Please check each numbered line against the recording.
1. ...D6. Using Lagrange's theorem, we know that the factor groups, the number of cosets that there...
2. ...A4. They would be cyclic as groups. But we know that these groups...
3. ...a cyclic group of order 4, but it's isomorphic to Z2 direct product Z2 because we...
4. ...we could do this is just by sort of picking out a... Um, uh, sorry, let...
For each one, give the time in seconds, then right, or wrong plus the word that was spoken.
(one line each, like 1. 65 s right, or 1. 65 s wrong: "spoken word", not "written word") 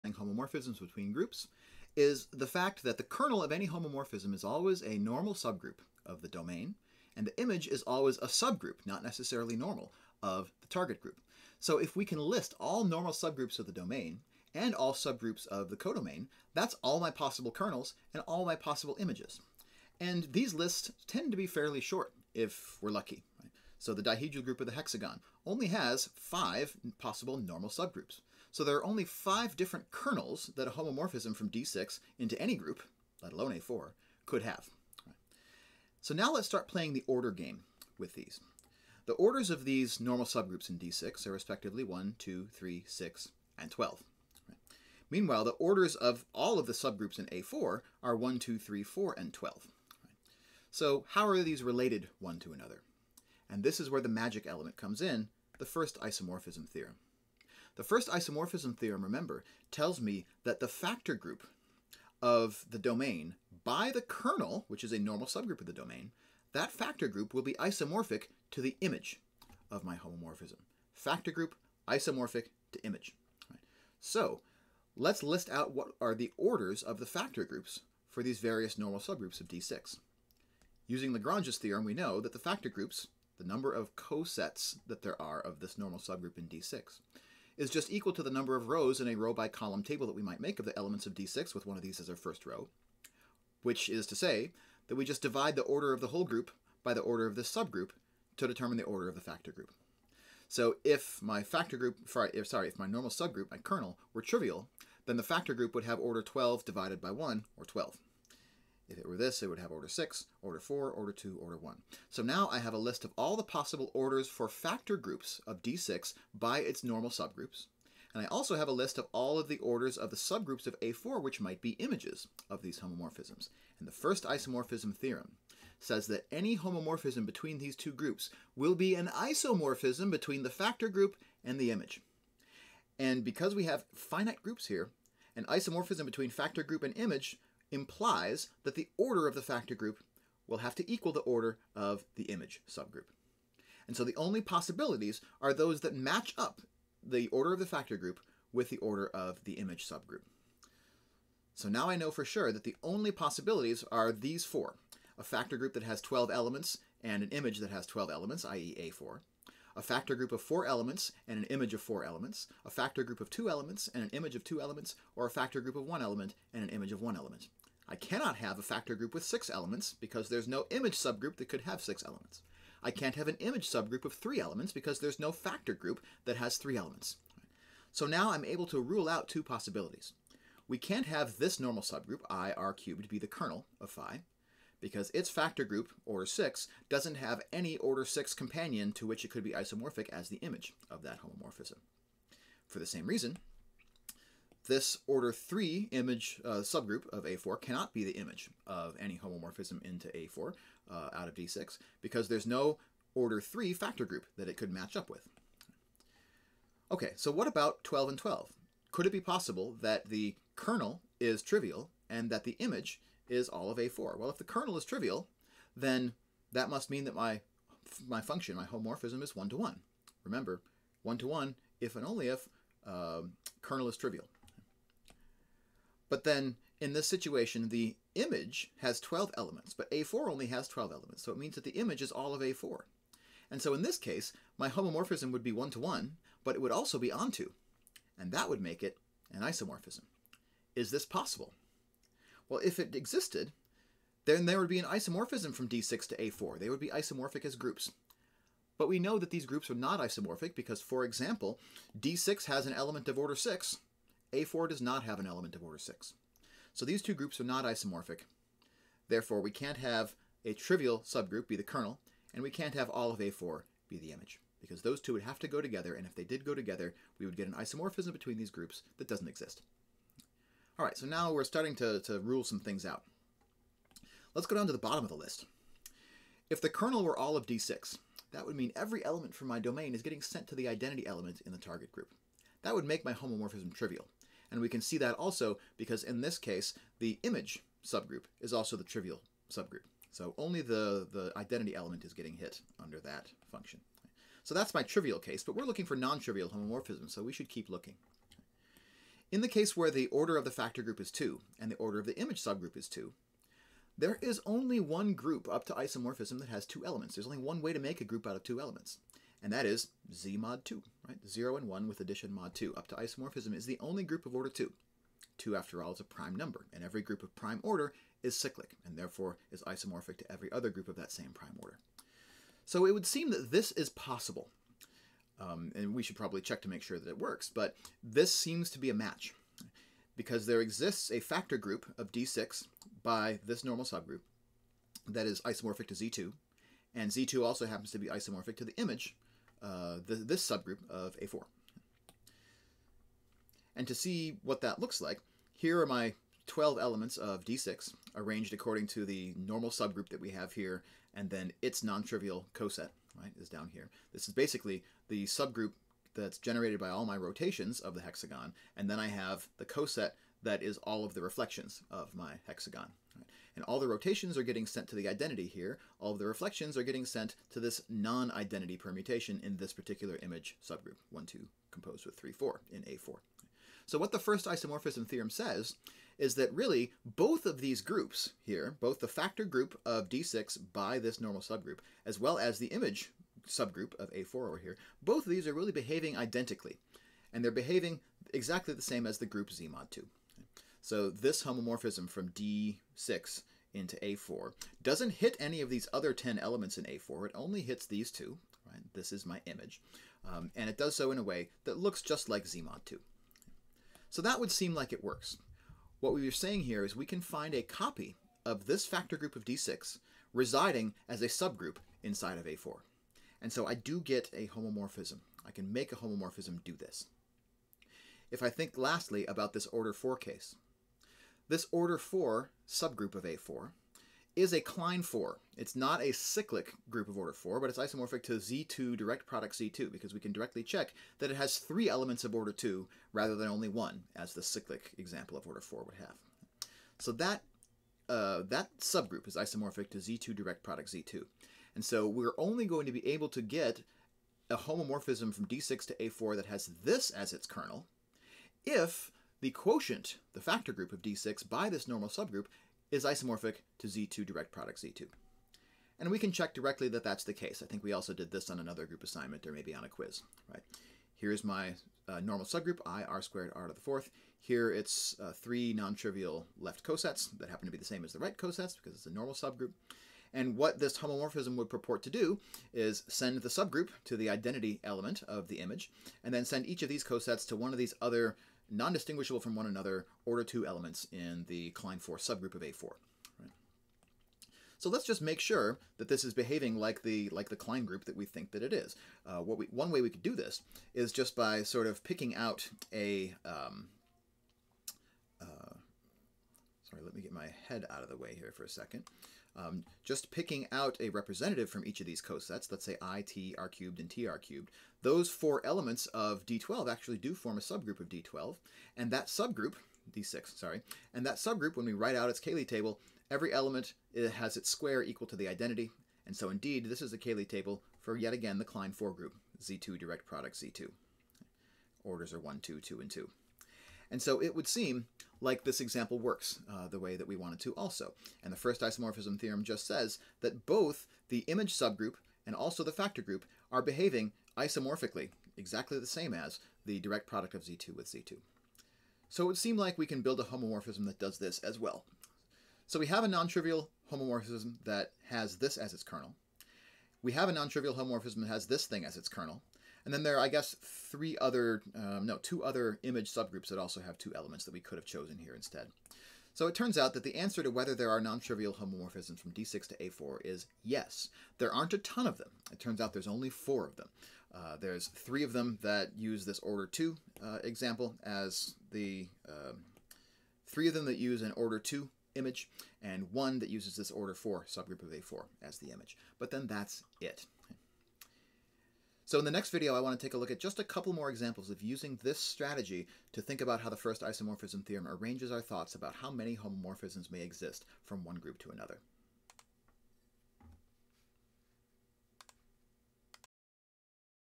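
1. 79 s right
2. 246 s wrong: "isomorphic", not "cyclic"
3. 426 s right
4. 490 s right.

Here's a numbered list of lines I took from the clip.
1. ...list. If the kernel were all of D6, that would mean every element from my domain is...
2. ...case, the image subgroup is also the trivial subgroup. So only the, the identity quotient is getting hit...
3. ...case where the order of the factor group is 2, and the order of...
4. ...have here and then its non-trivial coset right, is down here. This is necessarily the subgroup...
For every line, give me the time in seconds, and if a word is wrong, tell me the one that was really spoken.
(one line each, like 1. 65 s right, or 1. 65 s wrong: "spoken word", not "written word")
1. 275 s right
2. 286 s wrong: "element", not "quotient"
3. 299 s right
4. 350 s wrong: "basically", not "necessarily".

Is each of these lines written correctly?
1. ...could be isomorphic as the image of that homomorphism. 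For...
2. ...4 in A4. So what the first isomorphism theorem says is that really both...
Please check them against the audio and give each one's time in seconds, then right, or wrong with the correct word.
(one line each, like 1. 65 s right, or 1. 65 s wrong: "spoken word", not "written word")
1. 189 s right
2. 372 s right.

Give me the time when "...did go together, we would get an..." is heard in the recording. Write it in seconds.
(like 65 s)
266 s.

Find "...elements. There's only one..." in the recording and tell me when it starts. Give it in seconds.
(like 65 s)
306 s.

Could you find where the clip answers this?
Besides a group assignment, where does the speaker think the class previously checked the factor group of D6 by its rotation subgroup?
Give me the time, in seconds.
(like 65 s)
459 s.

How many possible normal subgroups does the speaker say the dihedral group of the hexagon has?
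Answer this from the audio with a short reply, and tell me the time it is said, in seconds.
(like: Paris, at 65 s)
5, at 26 s.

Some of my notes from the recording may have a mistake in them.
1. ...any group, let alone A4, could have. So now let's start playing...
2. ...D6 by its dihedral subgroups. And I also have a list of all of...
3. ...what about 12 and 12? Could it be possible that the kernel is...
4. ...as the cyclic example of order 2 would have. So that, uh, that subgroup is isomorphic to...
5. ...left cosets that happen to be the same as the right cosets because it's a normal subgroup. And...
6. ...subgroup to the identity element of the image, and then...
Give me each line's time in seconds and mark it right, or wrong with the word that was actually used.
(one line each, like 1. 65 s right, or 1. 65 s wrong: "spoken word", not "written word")
1. 32 s right
2. 115 s wrong: "normal", not "dihedral"
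3. 207 s right
4. 434 s wrong: "4", not "2"
5. 466 s right
6. 473 s right.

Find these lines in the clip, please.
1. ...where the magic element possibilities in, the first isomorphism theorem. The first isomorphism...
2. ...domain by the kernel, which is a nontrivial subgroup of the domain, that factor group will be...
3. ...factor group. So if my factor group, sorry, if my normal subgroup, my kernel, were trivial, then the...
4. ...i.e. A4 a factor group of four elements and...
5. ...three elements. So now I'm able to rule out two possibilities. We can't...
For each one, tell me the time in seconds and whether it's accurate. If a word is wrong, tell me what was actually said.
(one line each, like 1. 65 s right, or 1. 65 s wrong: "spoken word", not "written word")
1. 53 s wrong: "comes", not "possibilities"
2. 62 s wrong: "normal", not "nontrivial"
3. 99 s right
4. 158 s right
5. 176 s right.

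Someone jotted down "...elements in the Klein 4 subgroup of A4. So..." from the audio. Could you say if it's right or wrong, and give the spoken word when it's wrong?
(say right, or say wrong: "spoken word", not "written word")
right.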